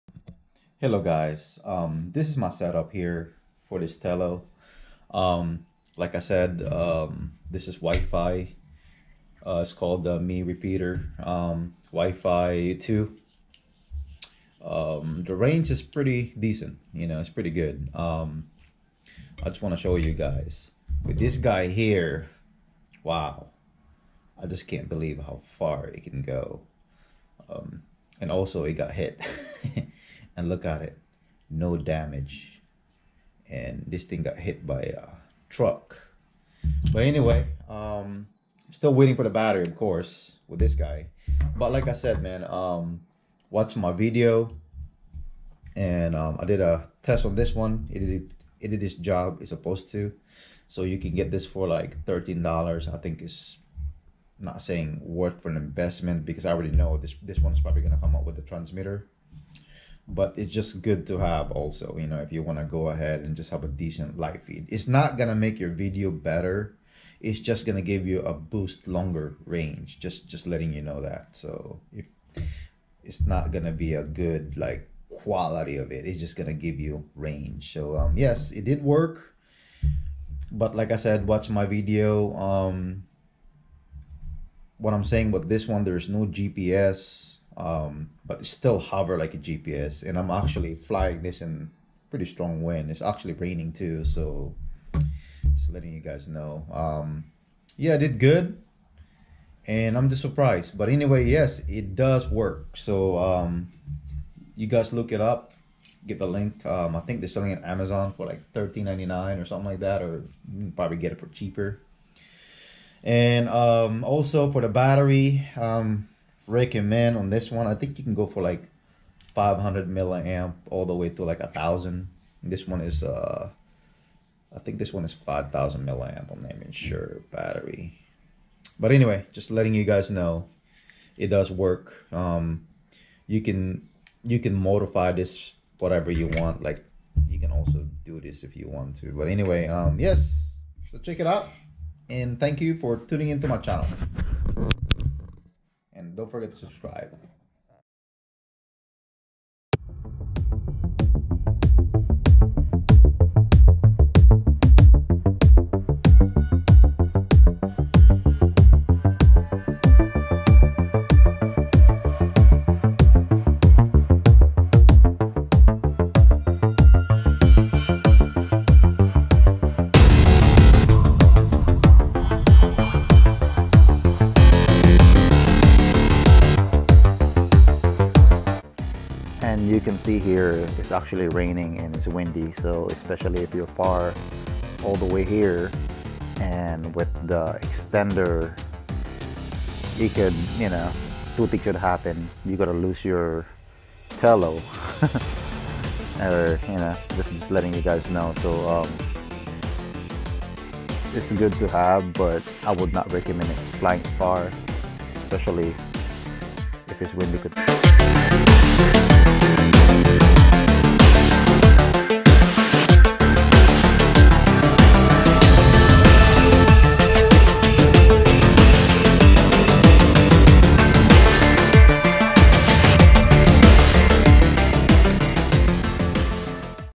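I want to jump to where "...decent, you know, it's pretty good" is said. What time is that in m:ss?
0:16.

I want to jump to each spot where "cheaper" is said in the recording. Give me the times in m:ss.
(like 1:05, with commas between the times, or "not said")
1:51.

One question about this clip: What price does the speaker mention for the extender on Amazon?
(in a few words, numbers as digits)
$13.99.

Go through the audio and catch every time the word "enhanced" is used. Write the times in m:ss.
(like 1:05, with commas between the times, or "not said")
not said.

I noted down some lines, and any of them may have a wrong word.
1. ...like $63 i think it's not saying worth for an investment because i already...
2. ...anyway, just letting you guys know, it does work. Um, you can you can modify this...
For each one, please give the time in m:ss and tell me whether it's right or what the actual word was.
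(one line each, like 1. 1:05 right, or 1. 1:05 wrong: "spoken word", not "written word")
1. 0:51 wrong: "13", not "63"
2. 2:08 right.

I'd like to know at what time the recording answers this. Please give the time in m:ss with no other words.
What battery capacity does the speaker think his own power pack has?
2:05.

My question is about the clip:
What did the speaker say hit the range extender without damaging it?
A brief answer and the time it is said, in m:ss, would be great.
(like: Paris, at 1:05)
A truck, at 0:34.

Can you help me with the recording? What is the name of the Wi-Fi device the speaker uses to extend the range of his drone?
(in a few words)
Mi Repeater.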